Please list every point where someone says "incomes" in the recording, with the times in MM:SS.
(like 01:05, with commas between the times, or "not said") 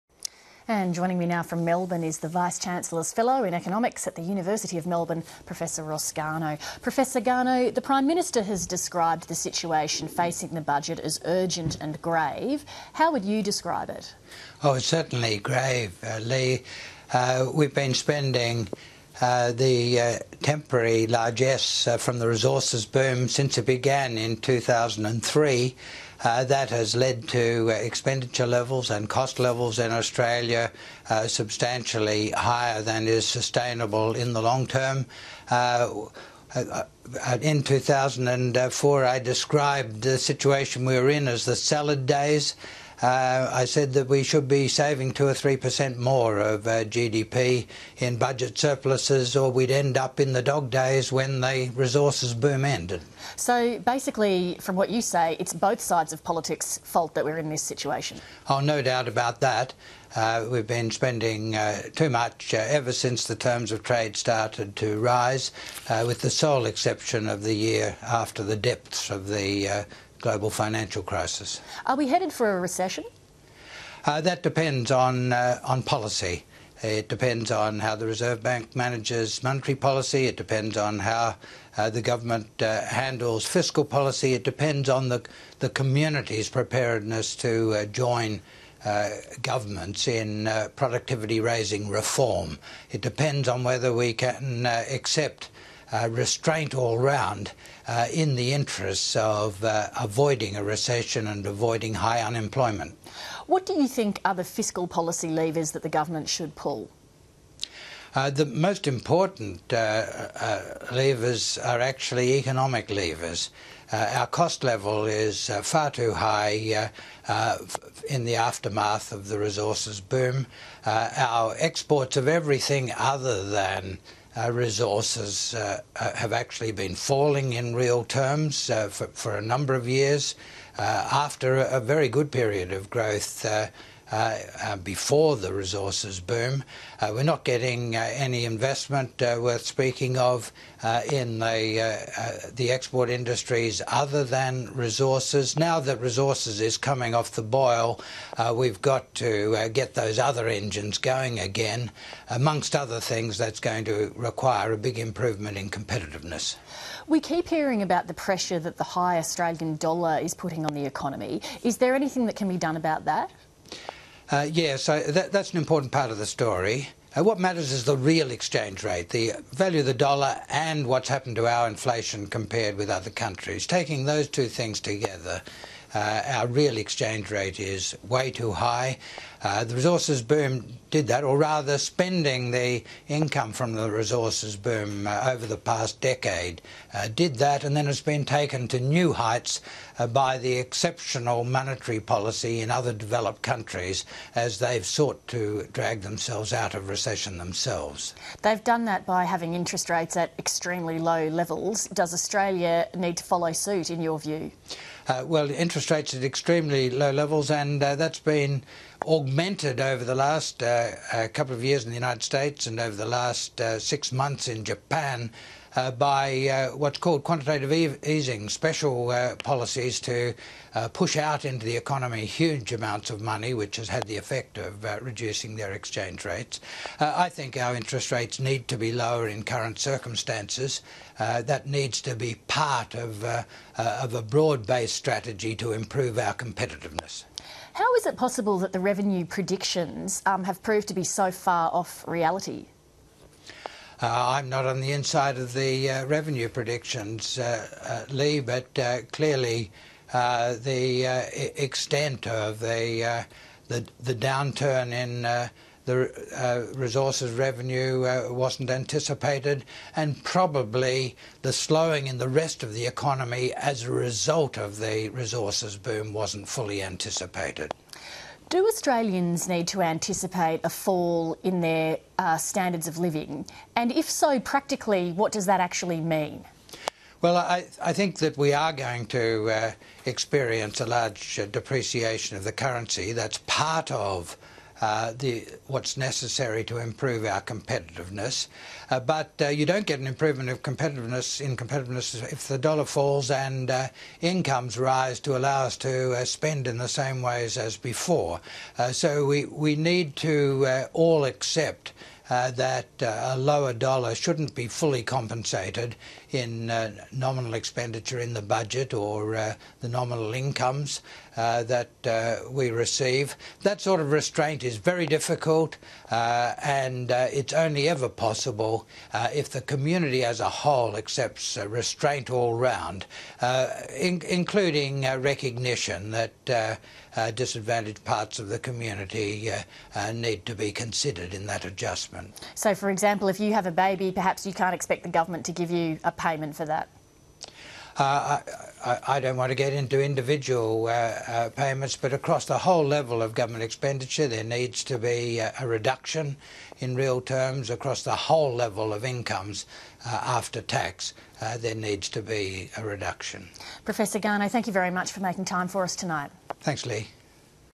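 03:03, 04:54, 05:10, 05:49.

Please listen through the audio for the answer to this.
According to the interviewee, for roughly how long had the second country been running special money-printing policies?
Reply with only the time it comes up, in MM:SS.
03:33.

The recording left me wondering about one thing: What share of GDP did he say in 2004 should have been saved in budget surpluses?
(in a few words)
2 or 3%.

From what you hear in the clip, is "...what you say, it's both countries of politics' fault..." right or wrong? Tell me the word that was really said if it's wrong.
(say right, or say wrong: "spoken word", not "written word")
wrong: "sides", not "countries".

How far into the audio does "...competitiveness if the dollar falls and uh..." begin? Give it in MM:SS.
04:51.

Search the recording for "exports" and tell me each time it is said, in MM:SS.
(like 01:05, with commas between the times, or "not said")
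02:01, 02:22.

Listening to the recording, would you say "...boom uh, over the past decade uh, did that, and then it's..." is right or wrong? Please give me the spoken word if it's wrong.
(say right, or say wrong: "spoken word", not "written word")
right.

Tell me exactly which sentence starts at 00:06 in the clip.
Professor Garnaut, the Prime Minister has described the situation facing the budget as urgent and grave.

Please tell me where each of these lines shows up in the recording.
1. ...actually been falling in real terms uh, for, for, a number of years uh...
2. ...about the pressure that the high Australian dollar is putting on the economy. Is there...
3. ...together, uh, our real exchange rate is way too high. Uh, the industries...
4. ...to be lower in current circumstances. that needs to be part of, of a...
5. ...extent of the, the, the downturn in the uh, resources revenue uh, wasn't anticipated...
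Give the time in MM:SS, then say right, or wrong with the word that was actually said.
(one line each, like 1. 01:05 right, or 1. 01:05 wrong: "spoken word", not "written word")
1. 02:06 right
2. 02:37 right
3. 02:54 wrong: "resources", not "industries"
4. 03:48 right
5. 04:11 right.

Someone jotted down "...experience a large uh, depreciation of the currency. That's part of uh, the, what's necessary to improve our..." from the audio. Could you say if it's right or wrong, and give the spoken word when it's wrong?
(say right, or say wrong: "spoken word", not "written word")
right.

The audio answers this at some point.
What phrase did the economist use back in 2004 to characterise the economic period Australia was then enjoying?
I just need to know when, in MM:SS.
00:41.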